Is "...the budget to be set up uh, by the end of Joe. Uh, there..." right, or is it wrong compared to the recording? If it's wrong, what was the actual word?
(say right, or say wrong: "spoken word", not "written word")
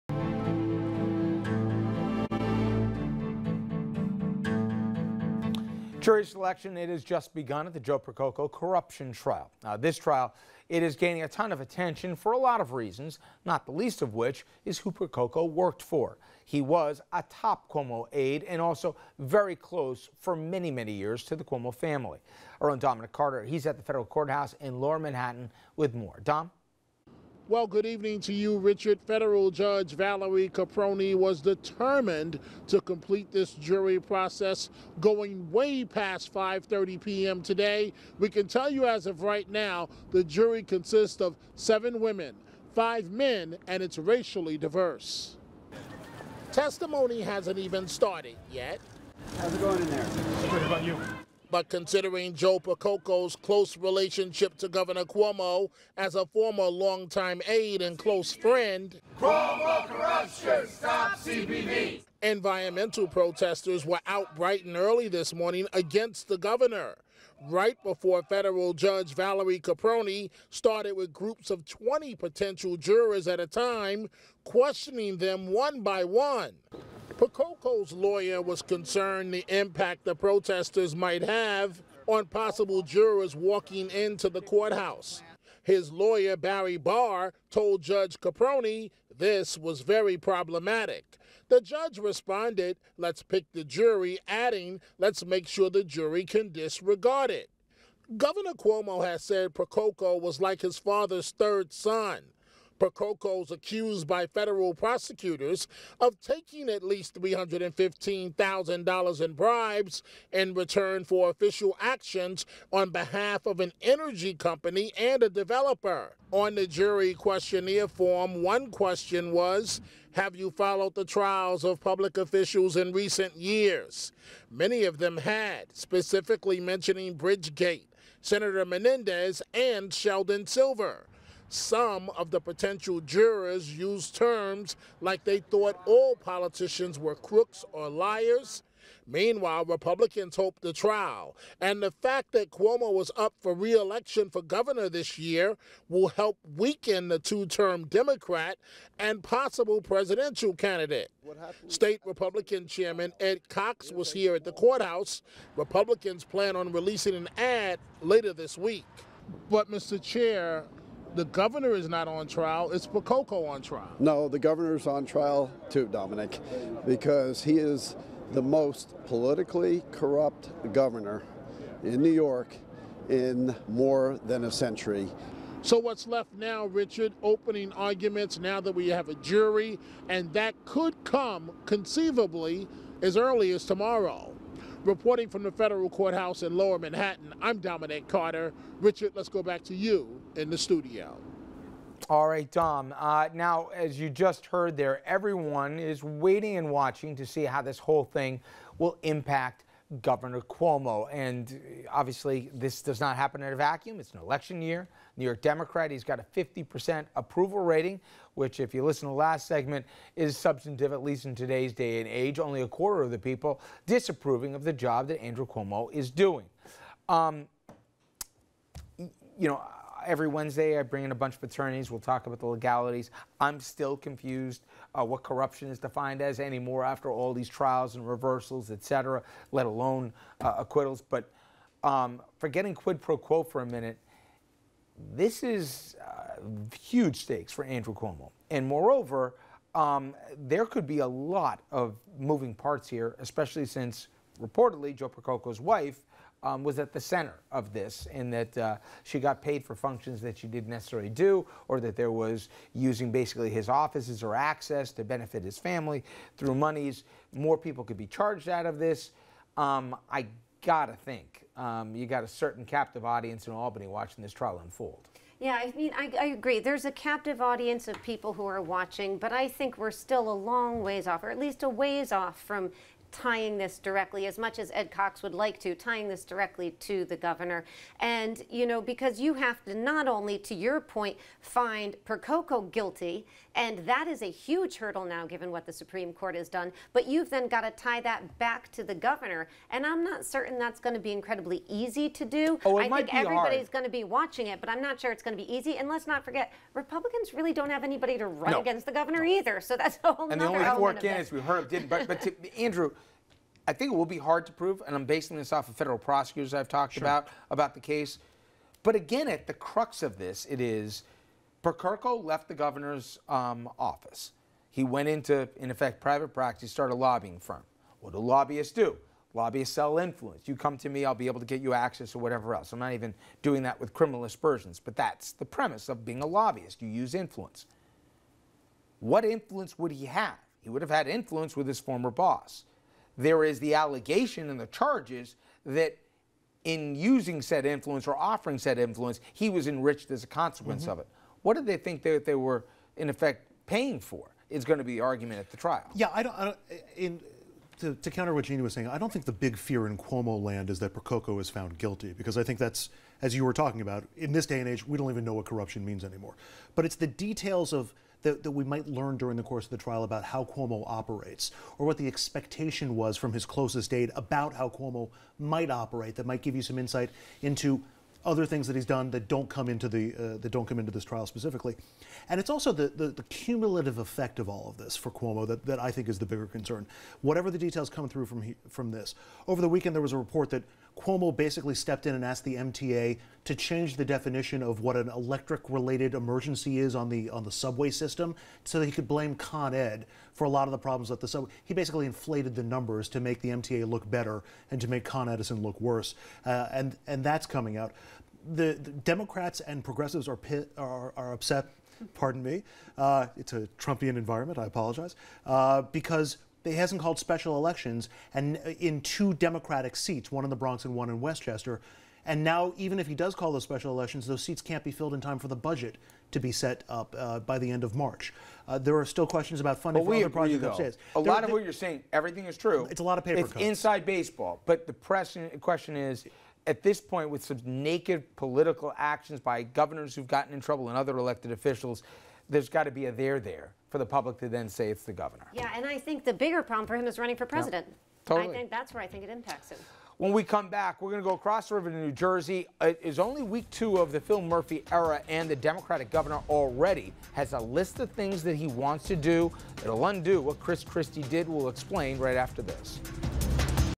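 wrong: "March", not "Joe".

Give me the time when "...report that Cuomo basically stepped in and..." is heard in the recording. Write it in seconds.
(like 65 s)
380 s.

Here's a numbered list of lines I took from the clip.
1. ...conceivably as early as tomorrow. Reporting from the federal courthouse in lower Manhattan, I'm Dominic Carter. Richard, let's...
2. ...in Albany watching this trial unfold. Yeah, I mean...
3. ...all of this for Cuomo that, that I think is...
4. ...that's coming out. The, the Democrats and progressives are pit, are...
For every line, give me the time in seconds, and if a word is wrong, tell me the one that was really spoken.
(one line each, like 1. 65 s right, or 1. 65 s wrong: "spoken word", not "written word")
1. 181 s right
2. 263 s right
3. 374 s right
4. 397 s right.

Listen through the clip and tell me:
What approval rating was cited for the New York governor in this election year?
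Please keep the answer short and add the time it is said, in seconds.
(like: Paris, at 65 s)
50%, at 206 s.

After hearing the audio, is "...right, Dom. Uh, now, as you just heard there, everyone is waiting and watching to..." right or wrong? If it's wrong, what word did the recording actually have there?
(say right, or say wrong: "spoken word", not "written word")
right.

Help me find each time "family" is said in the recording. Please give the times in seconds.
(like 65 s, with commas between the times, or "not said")
21 s, 255 s.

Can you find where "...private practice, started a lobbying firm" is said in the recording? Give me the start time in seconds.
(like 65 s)
316 s.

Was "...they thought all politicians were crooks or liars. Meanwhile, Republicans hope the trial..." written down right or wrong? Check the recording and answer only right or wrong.
right.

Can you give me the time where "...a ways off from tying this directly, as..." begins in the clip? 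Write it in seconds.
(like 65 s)
271 s.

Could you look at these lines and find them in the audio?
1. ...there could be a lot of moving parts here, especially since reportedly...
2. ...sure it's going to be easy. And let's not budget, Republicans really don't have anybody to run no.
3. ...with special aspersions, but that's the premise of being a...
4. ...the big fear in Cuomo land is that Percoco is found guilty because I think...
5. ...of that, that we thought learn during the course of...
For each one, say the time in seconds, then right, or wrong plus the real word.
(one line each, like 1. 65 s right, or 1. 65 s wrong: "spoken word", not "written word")
1. 240 s right
2. 294 s wrong: "forget", not "budget"
3. 323 s wrong: "criminal", not "special"
4. 349 s right
5. 357 s wrong: "might", not "thought".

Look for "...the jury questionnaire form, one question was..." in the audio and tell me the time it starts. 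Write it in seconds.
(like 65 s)
116 s.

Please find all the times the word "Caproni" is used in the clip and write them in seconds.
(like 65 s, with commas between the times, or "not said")
30 s, 69 s, 88 s.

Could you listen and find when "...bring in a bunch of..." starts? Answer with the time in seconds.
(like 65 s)
220 s.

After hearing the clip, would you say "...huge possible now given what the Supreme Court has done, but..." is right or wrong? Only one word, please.
wrong.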